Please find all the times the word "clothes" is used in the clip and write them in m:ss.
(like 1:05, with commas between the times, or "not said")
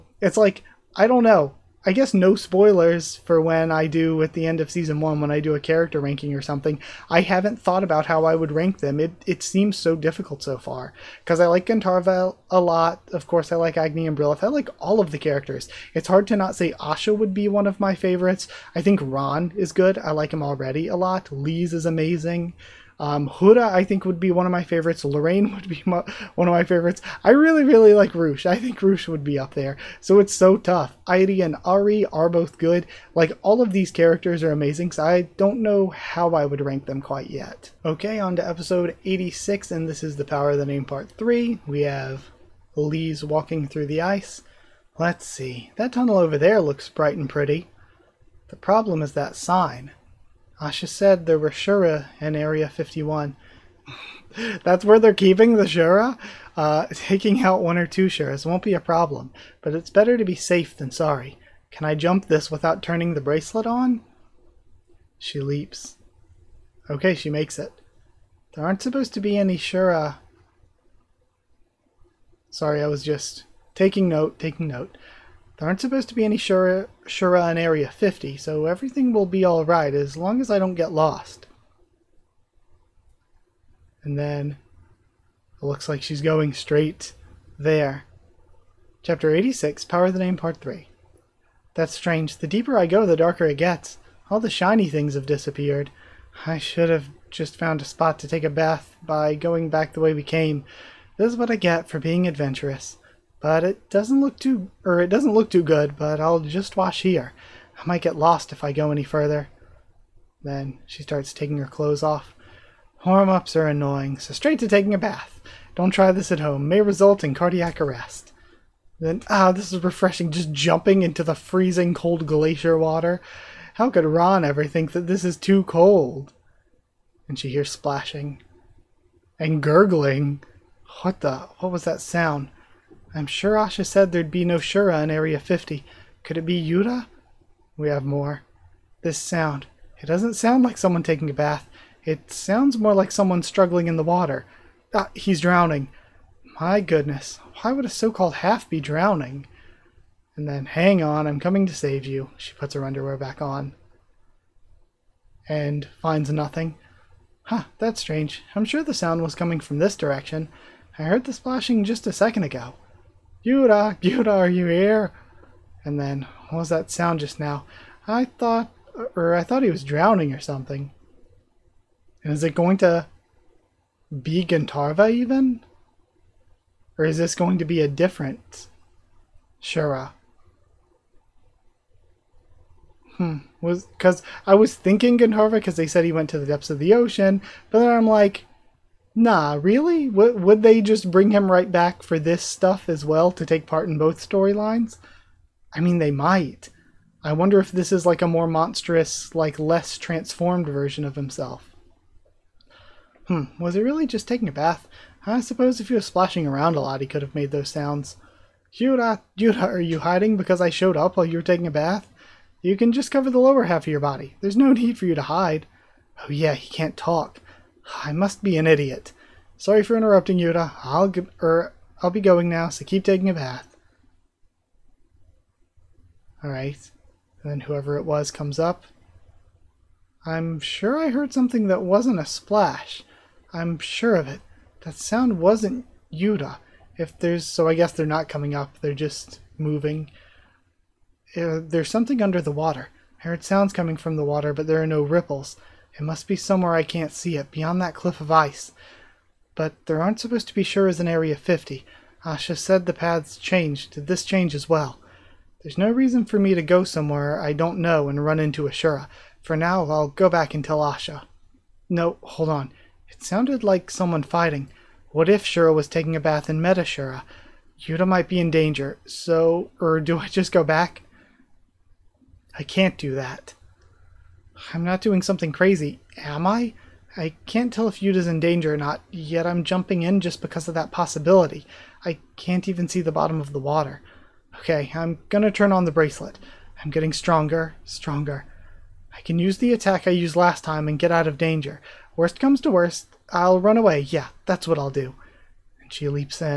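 1:51.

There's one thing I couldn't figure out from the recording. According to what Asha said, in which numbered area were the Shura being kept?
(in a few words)
Area 51.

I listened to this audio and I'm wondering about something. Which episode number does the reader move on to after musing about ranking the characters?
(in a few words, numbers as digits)
86.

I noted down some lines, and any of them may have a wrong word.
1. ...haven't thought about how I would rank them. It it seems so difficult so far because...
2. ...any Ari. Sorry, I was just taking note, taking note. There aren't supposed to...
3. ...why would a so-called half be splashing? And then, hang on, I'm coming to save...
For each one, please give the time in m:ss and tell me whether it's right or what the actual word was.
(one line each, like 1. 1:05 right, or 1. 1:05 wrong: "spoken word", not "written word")
1. 0:07 right
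2. 1:09 wrong: "Shura", not "Ari"
3. 2:27 wrong: "drowning", not "splashing".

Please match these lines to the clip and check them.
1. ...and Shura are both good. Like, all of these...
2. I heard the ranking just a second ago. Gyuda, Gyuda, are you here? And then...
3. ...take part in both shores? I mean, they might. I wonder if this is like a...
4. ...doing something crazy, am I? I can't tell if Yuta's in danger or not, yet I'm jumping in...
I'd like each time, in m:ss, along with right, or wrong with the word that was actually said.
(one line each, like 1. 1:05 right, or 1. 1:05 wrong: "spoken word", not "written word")
1. 0:31 wrong: "Ari", not "Shura"
2. 2:40 wrong: "splashing", not "ranking"
3. 3:13 wrong: "storylines", not "shores"
4. 4:35 right.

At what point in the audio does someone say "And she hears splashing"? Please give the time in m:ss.
2:07.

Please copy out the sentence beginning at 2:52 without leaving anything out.
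And is it going to be Gandharva even?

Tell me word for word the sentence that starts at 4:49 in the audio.
I can use the attack I used last time and get out of danger.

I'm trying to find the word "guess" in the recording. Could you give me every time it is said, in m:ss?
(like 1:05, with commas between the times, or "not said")
0:01, 3:57.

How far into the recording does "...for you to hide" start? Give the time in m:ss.
3:34.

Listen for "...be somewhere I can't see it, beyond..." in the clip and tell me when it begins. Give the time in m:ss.
4:06.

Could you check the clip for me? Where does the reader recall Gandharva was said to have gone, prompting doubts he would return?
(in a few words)
the depths of the ocean.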